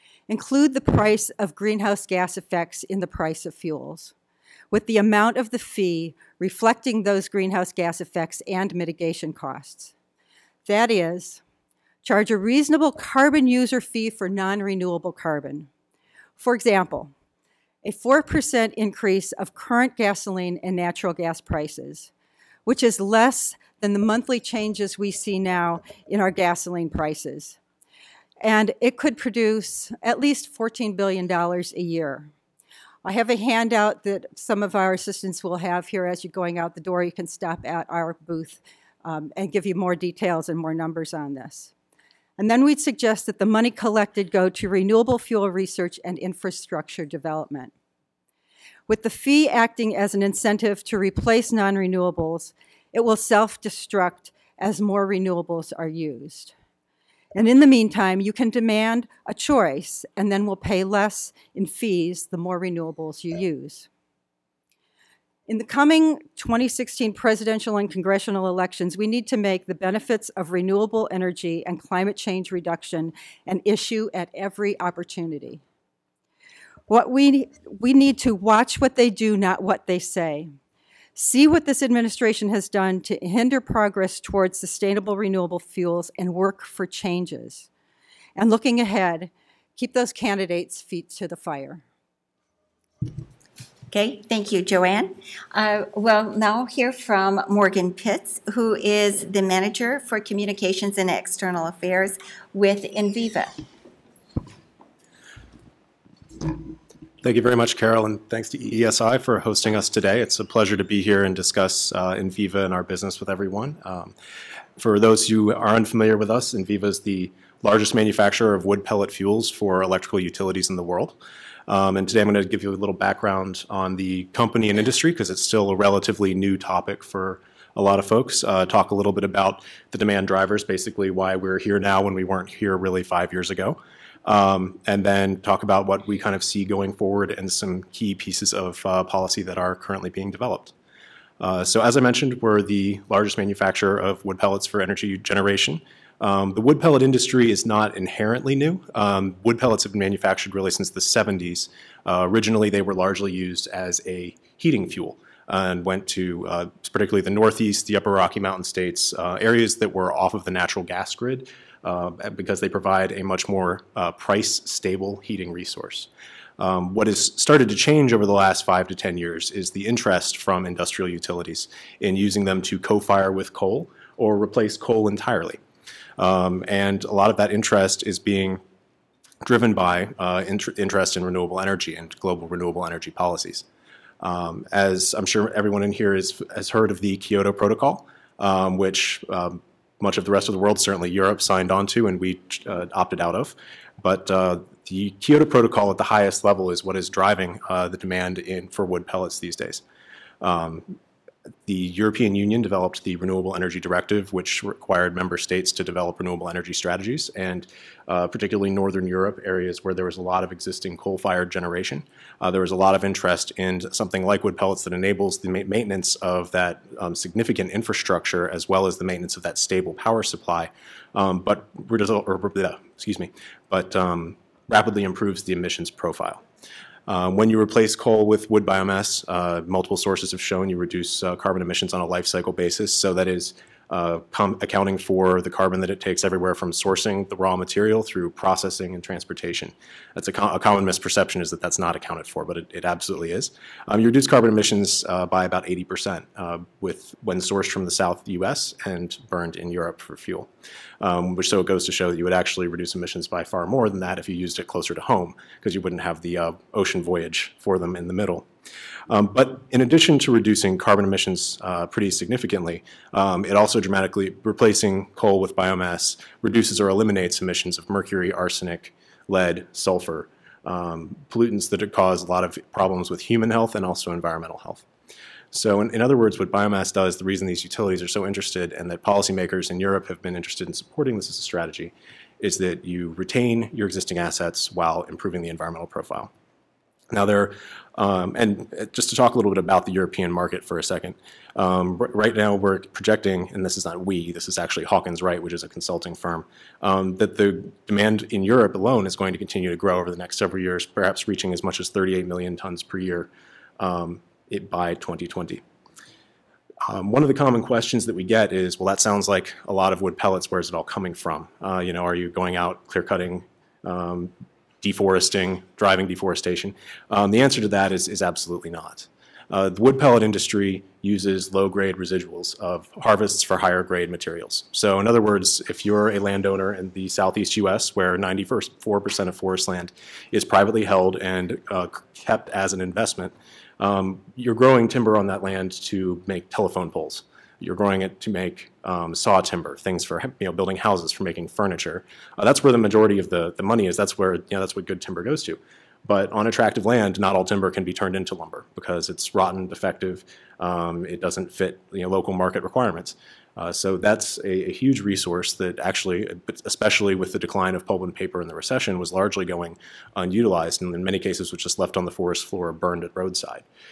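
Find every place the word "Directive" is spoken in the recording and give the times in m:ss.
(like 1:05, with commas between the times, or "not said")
3:23.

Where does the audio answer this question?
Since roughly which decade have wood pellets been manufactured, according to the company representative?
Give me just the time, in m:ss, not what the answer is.
2:30.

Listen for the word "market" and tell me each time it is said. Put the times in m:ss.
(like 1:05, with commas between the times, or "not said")
4:50, 5:52.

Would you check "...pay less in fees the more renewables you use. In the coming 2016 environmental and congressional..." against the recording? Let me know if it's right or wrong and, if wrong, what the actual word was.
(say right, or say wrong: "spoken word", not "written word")
wrong: "presidential", not "environmental".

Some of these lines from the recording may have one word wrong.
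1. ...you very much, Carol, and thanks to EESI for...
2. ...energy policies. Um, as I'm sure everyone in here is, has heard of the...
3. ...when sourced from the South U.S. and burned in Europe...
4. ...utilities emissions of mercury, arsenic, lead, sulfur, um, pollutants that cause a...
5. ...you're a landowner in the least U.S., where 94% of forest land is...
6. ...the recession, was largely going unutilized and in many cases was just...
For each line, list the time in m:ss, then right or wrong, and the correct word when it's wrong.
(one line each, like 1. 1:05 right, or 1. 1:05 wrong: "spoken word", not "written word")
1. 1:47 right
2. 3:02 right
3. 4:07 right
4. 4:26 wrong: "eliminates", not "utilities"
5. 5:25 wrong: "southeast", not "least"
6. 5:58 right.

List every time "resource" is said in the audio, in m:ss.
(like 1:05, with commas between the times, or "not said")
2:45, 5:55.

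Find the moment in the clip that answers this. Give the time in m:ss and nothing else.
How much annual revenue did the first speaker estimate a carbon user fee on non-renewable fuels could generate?
0:30.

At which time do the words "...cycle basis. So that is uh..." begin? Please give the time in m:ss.
3:52.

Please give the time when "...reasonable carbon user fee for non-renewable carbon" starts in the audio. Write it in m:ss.
0:12.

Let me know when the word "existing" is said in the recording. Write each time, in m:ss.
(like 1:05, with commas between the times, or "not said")
3:30, 4:43.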